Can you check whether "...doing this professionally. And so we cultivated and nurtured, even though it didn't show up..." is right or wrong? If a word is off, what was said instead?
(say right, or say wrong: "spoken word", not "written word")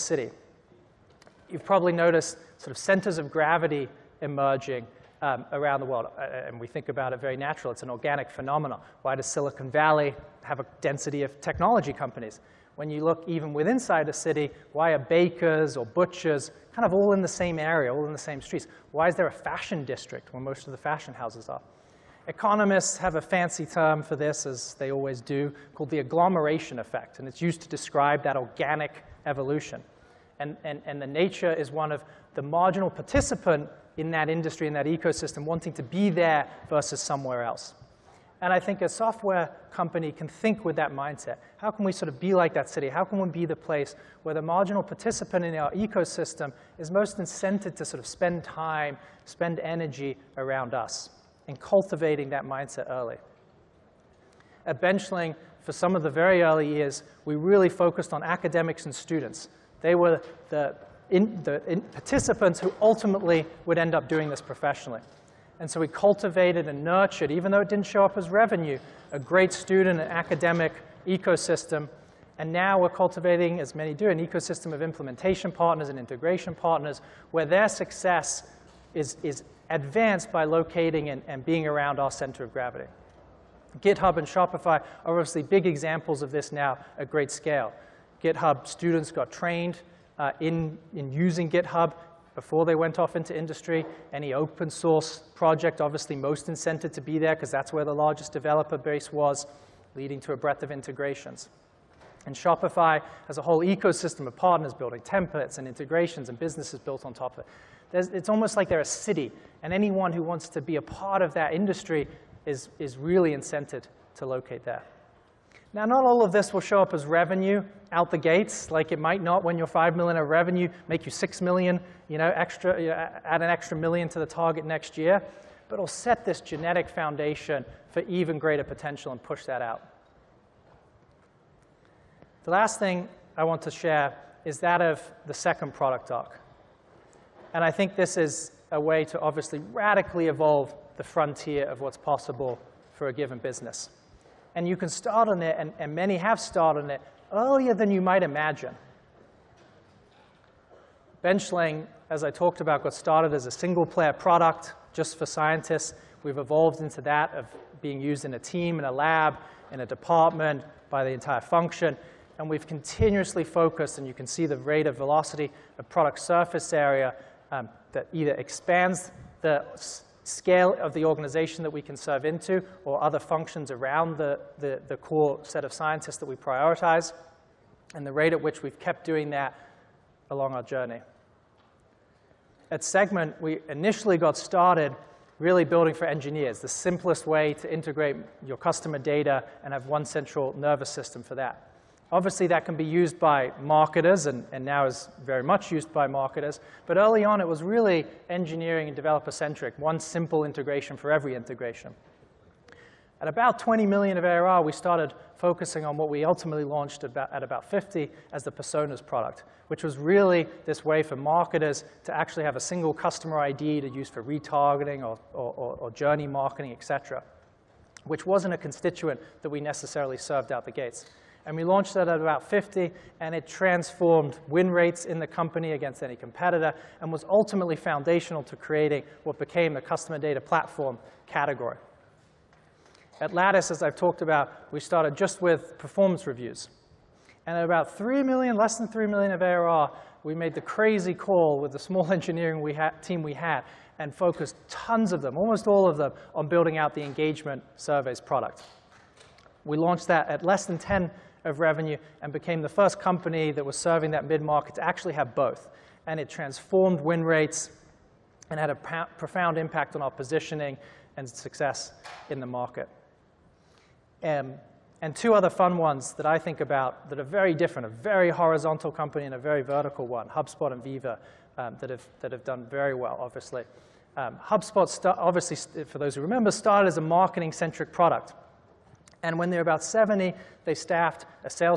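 right.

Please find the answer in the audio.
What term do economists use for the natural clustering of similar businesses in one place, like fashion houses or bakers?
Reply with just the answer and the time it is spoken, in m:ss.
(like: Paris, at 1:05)
agglomeration effect, at 0:25.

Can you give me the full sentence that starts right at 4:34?
Um, HubSpot, obviously, for those who remember, started as a marketing-centric product.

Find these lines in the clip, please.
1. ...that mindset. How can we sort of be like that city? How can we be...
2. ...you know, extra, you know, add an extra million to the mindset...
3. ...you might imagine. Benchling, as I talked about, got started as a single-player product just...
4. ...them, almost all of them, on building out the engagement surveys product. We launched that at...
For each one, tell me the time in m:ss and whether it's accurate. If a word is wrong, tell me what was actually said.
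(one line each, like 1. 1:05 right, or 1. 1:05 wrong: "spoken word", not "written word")
1. 0:40 right
2. 2:02 wrong: "target", not "mindset"
3. 2:27 right
4. 4:05 right.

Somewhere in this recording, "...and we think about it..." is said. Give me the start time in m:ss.
0:06.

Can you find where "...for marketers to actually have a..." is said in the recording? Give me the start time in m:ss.
3:31.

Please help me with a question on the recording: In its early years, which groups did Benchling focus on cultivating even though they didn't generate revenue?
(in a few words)
academics and students.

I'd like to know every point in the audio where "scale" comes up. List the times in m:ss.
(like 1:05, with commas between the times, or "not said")
1:27, 2:50.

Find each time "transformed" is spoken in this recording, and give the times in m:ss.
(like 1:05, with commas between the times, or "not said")
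3:43, 4:16.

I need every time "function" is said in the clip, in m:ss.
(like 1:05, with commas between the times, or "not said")
2:41, 2:53.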